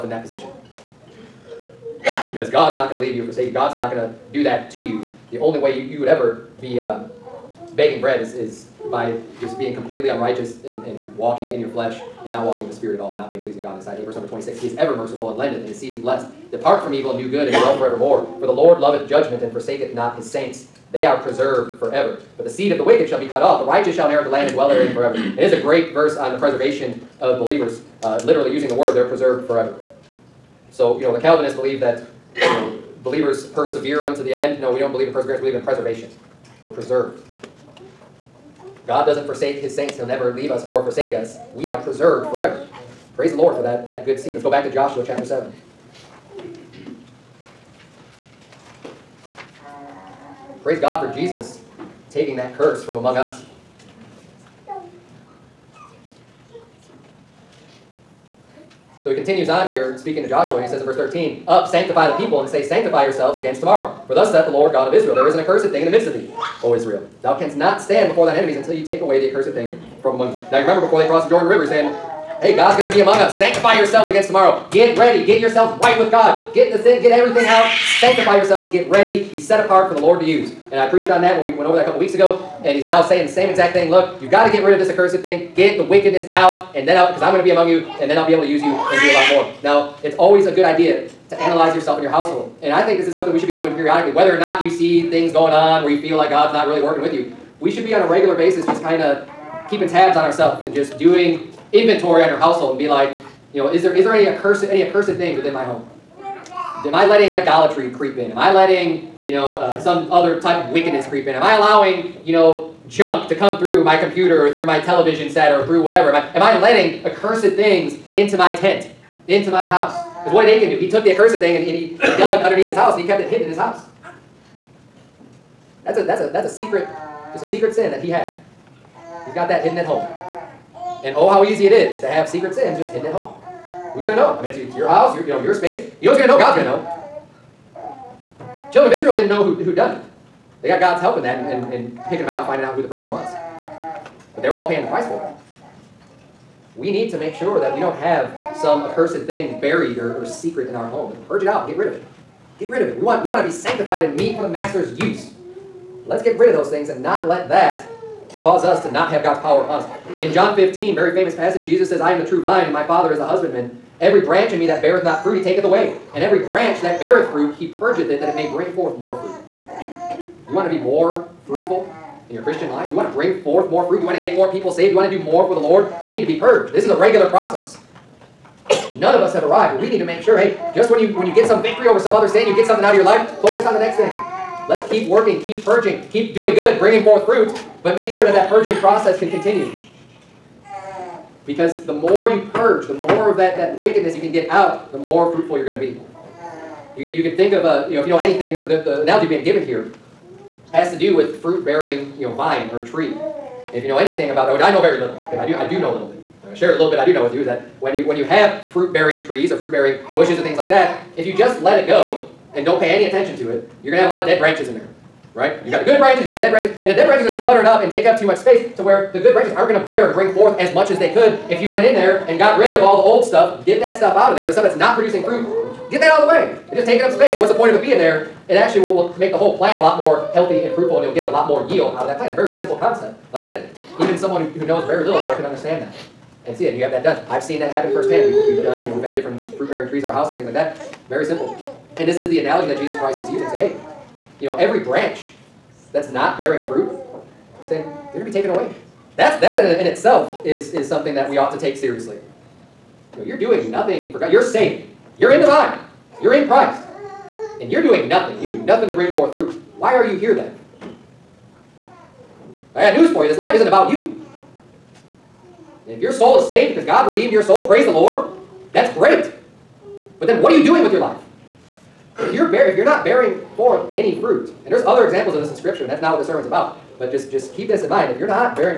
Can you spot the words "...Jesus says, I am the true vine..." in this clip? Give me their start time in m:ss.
2:41.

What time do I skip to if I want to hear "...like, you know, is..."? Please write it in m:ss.
1:42.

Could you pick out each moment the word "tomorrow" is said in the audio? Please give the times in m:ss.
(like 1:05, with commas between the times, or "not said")
1:03, 1:14.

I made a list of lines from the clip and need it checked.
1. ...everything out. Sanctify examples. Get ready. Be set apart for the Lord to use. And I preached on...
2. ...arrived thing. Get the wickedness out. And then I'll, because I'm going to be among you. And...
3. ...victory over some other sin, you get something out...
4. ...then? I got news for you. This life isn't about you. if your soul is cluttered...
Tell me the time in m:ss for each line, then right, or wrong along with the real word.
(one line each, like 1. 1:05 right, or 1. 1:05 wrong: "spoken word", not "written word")
1. 1:17 wrong: "yourselves", not "examples"
2. 1:24 wrong: "accursed", not "arrived"
3. 3:01 right
4. 4:20 wrong: "saved", not "cluttered".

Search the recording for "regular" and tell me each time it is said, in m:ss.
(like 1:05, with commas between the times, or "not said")
1:38, 2:56.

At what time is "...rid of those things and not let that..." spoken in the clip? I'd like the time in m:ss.
2:36.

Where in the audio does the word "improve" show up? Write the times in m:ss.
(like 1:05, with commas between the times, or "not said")
not said.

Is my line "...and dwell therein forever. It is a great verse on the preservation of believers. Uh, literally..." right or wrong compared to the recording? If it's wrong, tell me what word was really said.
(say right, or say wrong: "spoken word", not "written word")
right.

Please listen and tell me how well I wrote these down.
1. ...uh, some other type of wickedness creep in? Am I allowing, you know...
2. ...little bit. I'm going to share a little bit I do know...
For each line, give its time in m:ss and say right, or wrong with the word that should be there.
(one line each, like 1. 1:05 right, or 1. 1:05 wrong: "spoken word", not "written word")
1. 1:49 right
2. 3:25 right.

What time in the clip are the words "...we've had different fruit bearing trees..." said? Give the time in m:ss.
3:58.